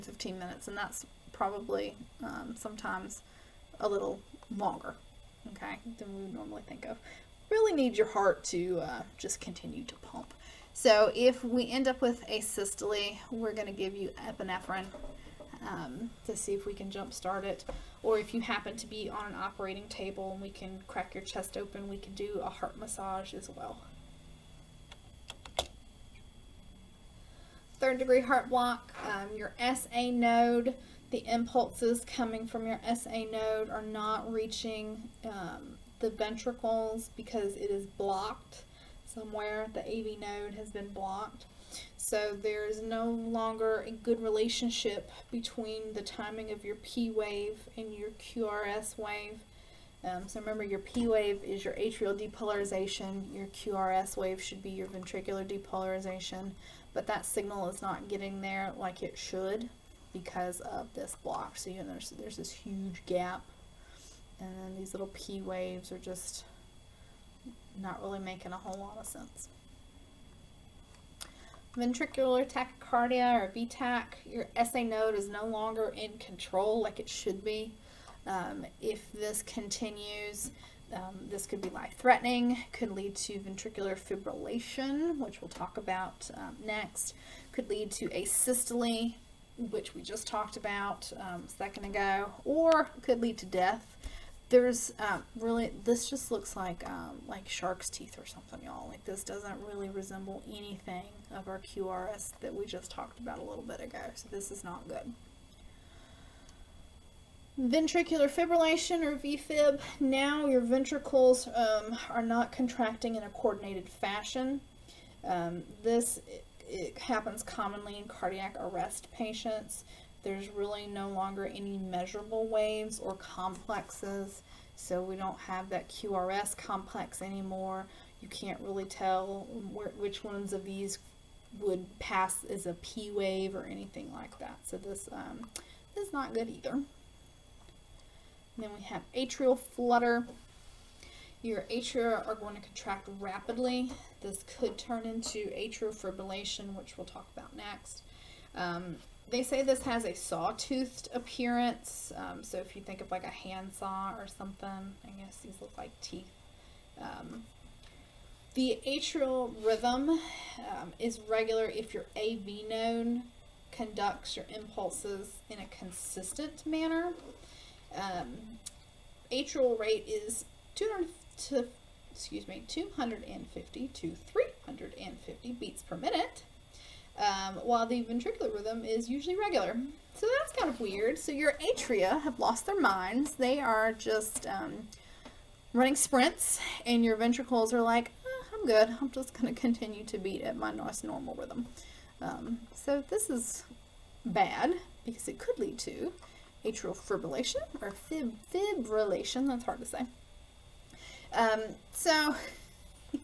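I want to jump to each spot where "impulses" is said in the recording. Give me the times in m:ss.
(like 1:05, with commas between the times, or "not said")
0:31, 2:44.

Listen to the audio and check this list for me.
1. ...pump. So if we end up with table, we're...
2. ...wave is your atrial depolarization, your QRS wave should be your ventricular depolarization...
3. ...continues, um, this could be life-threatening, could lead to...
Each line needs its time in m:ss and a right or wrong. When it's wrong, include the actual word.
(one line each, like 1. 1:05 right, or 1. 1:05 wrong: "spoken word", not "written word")
1. 0:09 wrong: "asystole", not "table"
2. 0:51 right
3. 1:19 right.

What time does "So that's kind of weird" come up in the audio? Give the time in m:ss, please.
3:00.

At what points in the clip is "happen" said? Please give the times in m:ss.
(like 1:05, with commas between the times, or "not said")
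0:18, 1:56.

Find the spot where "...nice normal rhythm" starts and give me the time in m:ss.
3:10.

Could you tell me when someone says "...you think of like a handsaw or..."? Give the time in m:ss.
2:32.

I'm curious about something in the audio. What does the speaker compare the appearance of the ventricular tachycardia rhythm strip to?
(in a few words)
shark's teeth.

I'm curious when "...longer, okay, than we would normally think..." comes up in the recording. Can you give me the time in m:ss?
0:04.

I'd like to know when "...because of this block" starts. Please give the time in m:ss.
1:00.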